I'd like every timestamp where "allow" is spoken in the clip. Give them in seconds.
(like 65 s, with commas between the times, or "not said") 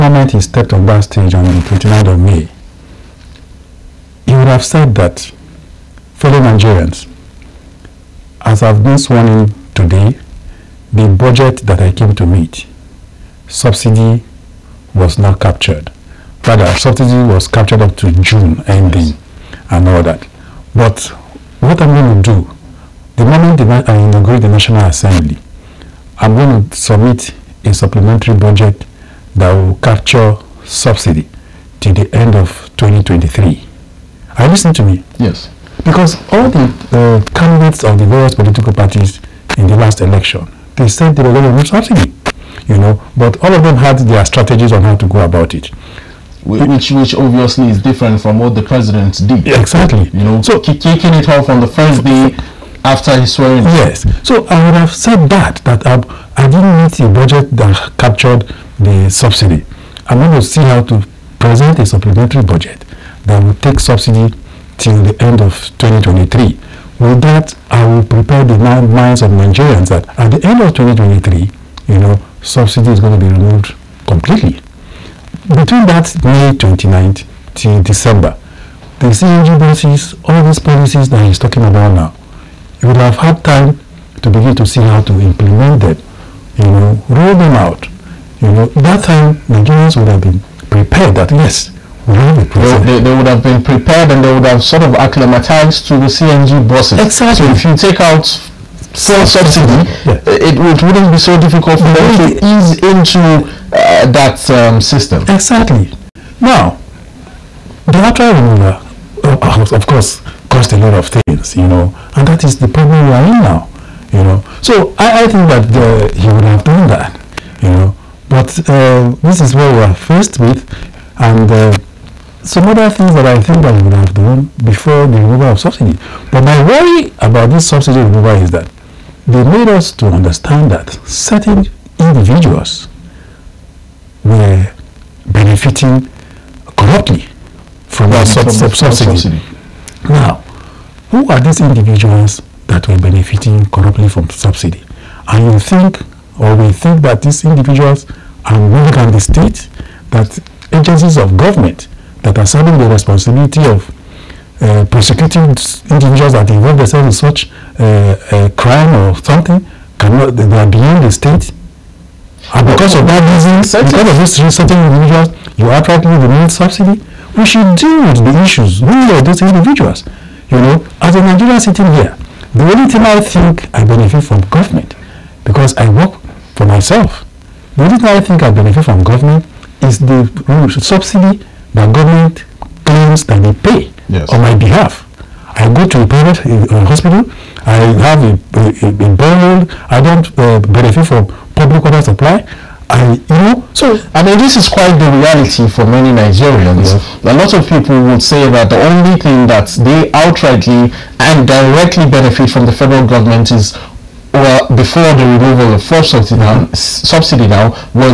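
not said.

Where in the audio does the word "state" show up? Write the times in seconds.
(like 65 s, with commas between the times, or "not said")
149 s, 161 s.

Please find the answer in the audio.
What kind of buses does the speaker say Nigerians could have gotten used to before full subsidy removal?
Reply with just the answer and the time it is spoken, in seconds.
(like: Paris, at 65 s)
CNG buses, at 96 s.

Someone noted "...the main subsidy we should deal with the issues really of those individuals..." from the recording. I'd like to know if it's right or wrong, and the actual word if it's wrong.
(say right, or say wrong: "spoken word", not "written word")
right.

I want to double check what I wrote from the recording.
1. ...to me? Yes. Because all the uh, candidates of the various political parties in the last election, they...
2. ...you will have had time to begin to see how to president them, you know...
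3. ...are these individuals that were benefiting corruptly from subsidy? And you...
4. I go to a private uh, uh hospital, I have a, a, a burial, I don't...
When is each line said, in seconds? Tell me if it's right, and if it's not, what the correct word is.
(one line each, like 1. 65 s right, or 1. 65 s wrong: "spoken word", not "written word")
1. 34 s right
2. 82 s wrong: "implement", not "president"
3. 141 s right
4. 185 s right.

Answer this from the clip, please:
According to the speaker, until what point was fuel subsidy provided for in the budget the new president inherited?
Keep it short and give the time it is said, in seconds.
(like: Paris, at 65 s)
June ending, at 18 s.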